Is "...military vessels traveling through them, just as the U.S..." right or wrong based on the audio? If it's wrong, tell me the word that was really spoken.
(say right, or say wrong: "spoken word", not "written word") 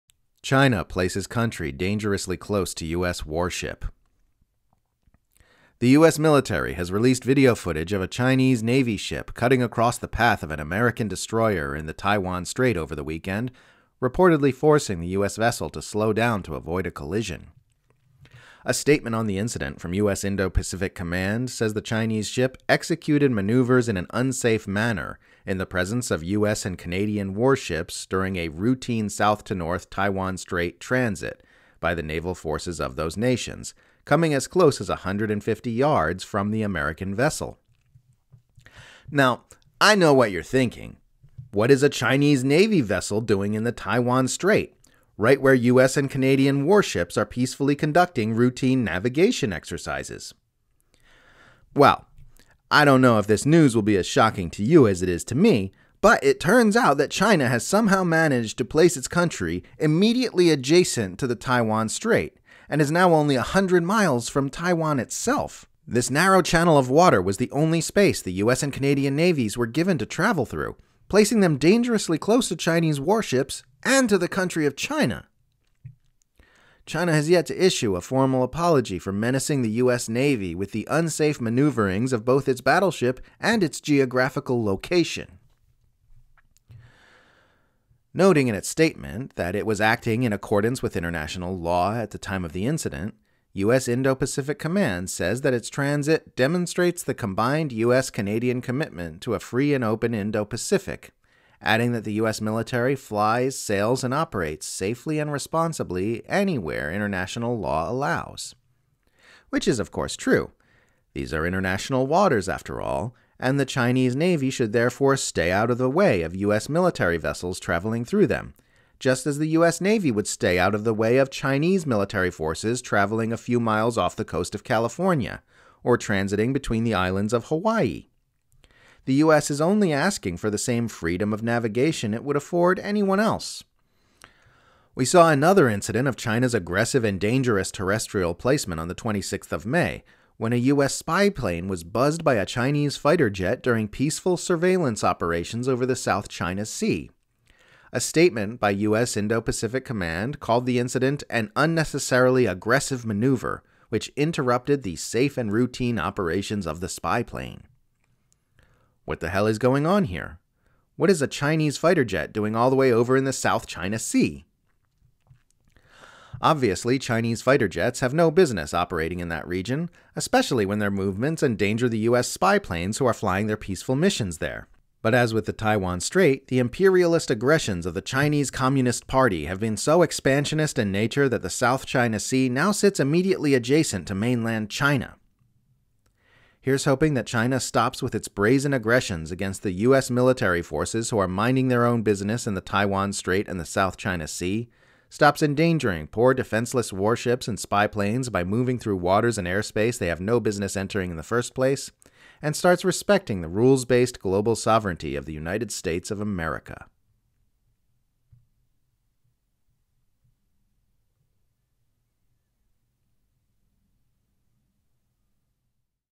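right.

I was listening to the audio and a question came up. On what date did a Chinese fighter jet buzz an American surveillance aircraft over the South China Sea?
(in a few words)
May 26.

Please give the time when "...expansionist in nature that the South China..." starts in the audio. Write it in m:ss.
3:00.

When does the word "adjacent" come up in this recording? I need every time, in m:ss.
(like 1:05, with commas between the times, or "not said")
1:00, 3:03.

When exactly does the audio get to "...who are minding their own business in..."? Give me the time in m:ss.
3:11.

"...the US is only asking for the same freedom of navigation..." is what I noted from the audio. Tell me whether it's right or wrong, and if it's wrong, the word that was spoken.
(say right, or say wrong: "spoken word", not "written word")
right.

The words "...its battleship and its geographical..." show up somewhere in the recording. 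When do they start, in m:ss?
1:22.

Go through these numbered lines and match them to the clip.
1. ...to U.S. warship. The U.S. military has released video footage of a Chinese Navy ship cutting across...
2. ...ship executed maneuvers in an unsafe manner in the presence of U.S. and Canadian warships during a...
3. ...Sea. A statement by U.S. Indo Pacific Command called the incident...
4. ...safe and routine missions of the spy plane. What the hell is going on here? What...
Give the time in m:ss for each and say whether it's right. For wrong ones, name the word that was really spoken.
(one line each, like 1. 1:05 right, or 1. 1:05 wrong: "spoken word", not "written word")
1. 0:02 right
2. 0:22 right
3. 2:26 right
4. 2:34 wrong: "operations", not "missions".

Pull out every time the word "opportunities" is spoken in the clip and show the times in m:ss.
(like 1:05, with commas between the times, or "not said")
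not said.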